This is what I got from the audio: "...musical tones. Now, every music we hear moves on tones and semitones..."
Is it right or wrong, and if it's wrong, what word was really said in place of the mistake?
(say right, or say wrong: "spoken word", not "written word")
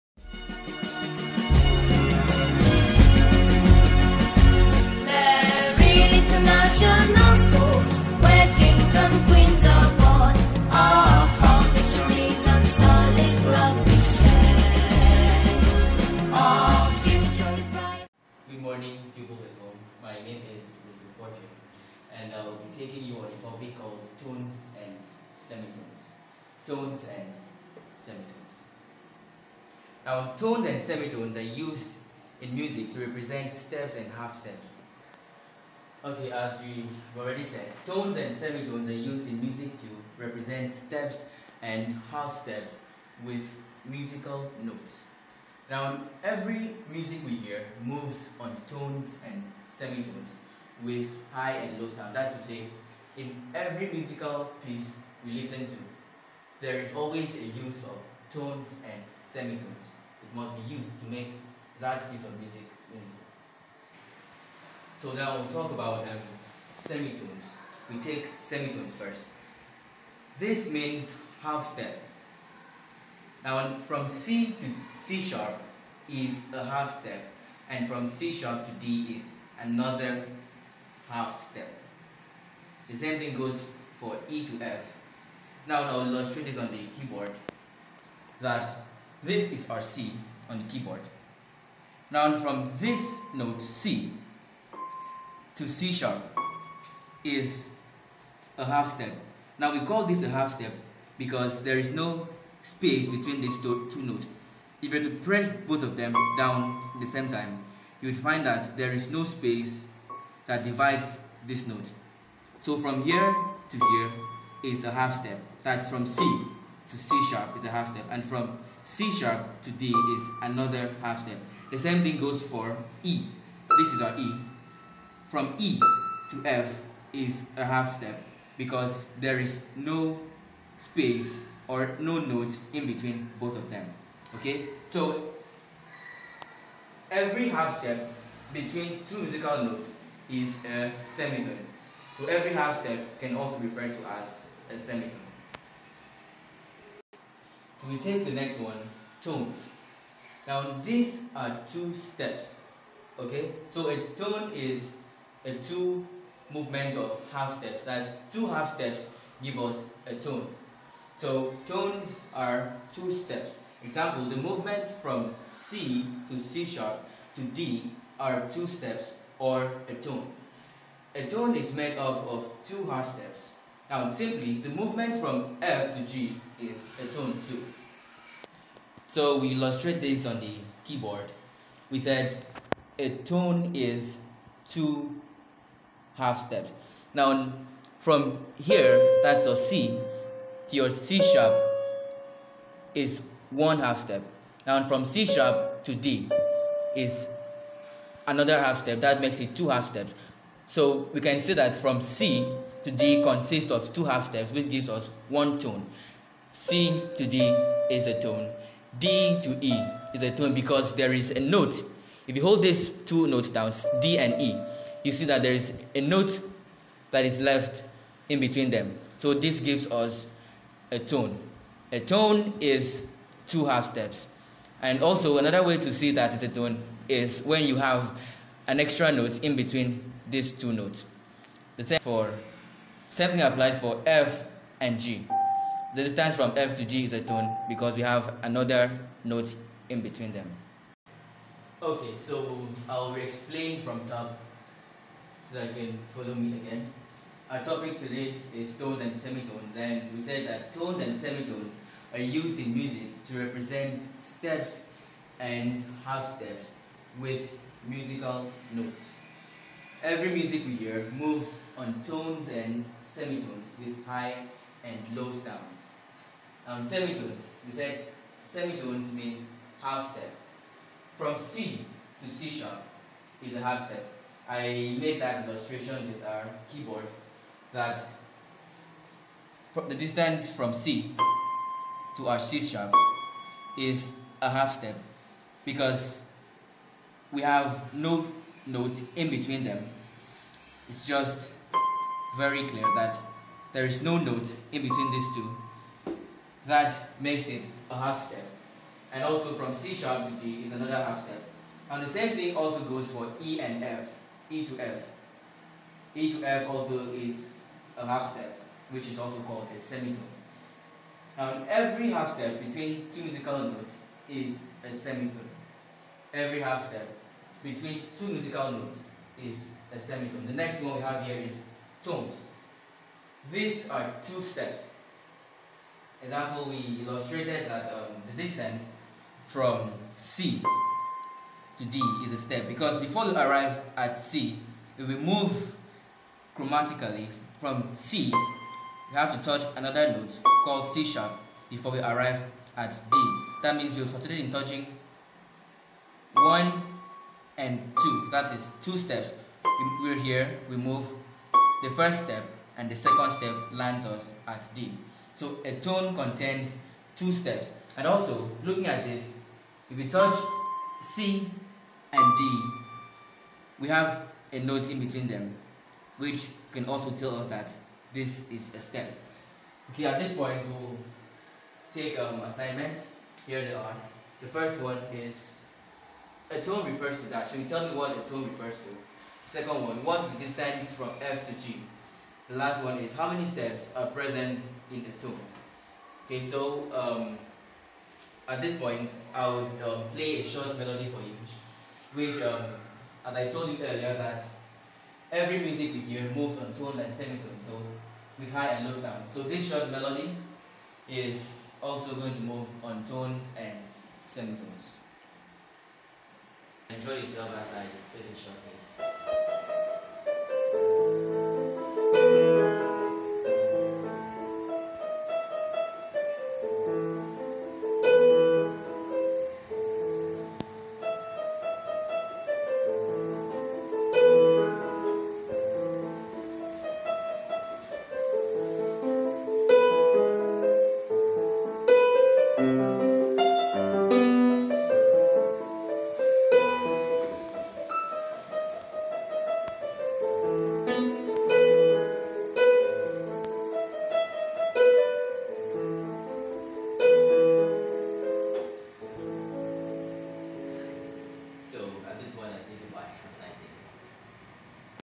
wrong: "notes", not "tones".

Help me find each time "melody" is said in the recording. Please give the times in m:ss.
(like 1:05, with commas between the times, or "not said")
6:30, 6:39.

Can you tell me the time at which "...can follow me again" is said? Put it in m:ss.
4:05.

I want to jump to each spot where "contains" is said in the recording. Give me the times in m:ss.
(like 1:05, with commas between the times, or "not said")
5:56.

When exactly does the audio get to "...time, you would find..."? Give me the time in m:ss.
1:47.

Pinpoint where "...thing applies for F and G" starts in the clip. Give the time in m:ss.
3:53.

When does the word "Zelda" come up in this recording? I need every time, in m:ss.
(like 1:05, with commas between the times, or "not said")
not said.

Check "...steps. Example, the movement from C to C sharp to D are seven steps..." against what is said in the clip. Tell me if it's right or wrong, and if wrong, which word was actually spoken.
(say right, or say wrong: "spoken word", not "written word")
wrong: "two", not "seven".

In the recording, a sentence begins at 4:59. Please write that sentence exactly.
And also from C sharp to D is another half step.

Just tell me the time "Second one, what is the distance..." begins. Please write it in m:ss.
6:19.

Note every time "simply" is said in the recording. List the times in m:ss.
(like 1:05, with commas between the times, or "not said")
2:54.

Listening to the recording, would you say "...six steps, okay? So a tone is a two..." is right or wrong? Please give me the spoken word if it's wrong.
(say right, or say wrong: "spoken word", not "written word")
wrong: "two", not "six".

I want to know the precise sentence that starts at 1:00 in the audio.
It must be used to make that piece of music meaningful.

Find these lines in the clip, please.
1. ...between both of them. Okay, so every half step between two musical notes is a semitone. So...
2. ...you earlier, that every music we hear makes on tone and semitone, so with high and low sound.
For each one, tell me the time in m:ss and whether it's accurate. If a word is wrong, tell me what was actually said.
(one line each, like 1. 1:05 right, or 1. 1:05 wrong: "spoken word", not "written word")
1. 2:12 right
2. 6:33 wrong: "moves", not "makes".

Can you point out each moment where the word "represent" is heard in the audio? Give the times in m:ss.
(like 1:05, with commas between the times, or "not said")
0:32, 0:40, 4:13.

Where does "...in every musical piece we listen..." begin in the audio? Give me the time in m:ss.
0:53.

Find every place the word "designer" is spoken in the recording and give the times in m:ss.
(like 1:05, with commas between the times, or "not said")
not said.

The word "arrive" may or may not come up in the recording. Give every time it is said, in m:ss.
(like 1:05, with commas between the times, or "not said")
5:33, 5:41.